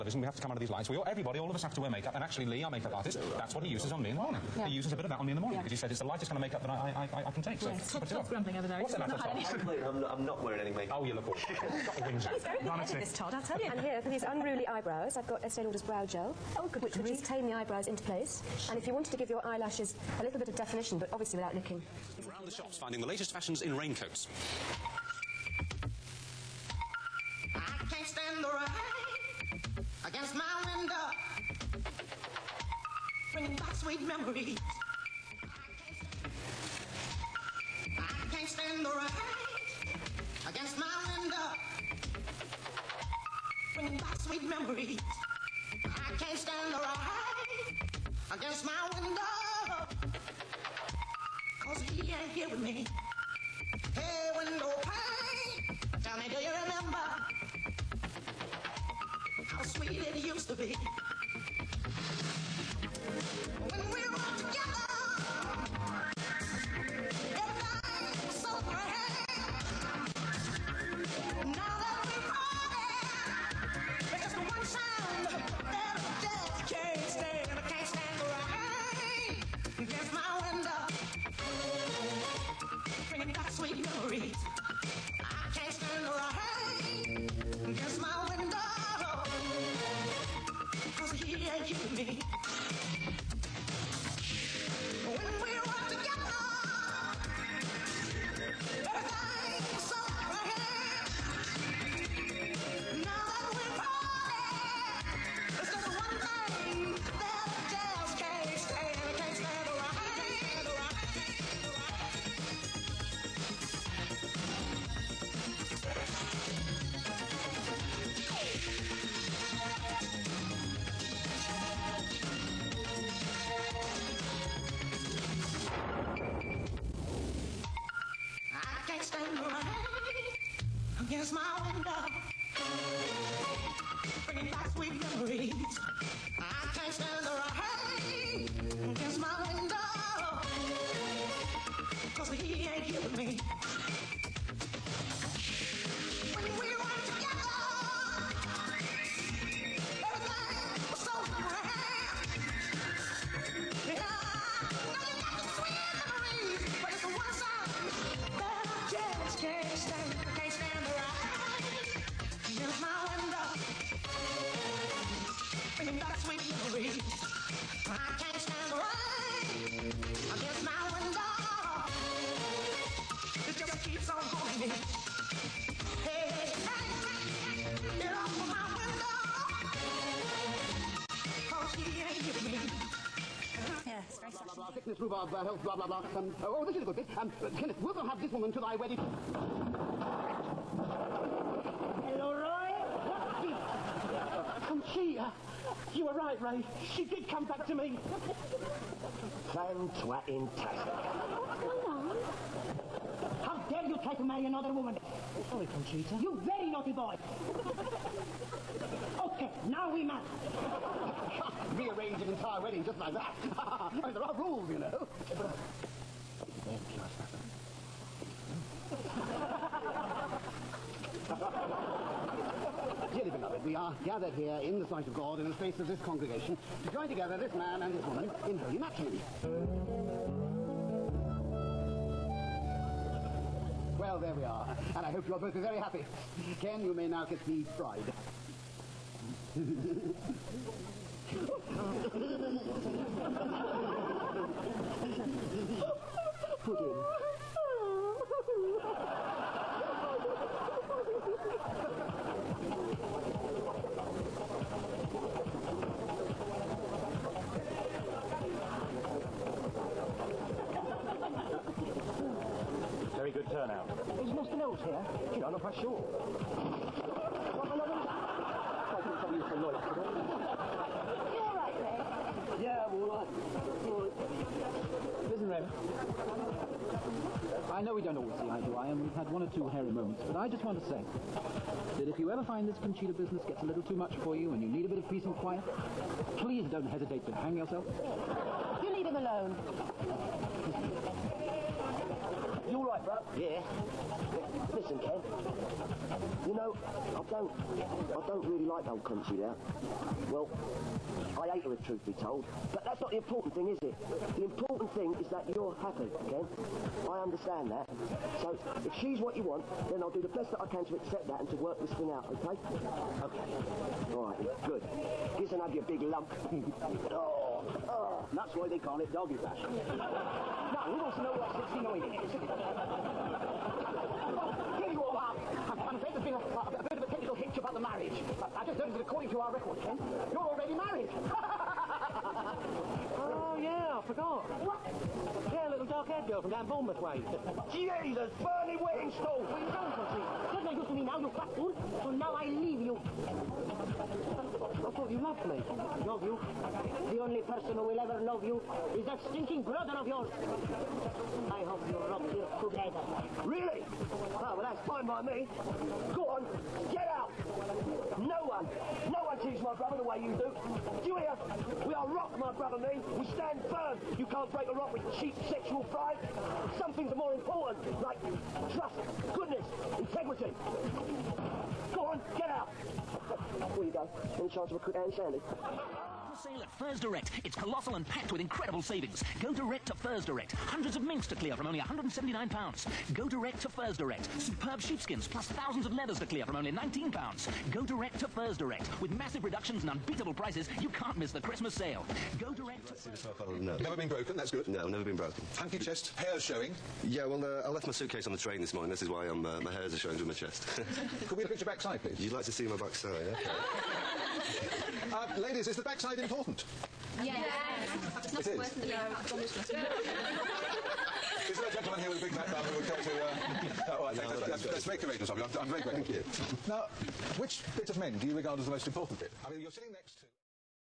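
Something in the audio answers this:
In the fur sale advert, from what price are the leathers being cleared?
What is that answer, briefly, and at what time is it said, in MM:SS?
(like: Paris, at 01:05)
£19, at 06:26.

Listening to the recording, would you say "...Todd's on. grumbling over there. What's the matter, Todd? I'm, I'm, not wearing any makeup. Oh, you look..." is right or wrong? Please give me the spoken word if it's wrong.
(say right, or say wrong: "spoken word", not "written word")
right.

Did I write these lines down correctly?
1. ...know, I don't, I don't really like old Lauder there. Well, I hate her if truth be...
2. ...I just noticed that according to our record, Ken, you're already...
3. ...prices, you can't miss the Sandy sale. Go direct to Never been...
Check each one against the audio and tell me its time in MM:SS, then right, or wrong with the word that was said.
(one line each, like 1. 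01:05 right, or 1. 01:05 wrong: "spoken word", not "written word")
1. 04:56 wrong: "Conchita", not "Lauder"
2. 05:28 right
3. 06:30 wrong: "Christmas", not "Sandy".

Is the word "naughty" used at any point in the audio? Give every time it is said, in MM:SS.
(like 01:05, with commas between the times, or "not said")
03:26.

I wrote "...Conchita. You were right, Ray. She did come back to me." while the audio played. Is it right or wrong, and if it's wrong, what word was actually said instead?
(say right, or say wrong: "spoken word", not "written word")
right.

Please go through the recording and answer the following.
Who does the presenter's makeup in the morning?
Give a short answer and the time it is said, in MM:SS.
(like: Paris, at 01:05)
Lee, at 00:02.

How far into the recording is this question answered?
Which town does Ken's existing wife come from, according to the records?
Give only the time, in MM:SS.
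05:36.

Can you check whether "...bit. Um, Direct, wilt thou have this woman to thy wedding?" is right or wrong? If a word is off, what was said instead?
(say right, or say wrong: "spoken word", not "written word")
wrong: "Kenneth", not "Direct".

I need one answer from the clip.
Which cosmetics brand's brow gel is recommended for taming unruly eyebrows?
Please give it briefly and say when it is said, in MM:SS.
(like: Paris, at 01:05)
Estee Lauder, at 00:15.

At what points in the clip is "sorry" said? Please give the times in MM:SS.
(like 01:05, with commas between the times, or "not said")
03:25.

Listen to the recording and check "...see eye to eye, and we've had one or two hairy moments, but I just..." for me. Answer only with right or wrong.
right.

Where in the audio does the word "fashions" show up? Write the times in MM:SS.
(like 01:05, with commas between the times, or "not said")
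00:23, 05:19.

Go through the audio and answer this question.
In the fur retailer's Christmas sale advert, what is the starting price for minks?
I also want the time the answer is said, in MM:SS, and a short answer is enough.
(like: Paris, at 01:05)
£179, at 06:21.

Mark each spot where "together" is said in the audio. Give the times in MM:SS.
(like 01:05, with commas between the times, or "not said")
03:47, 05:52.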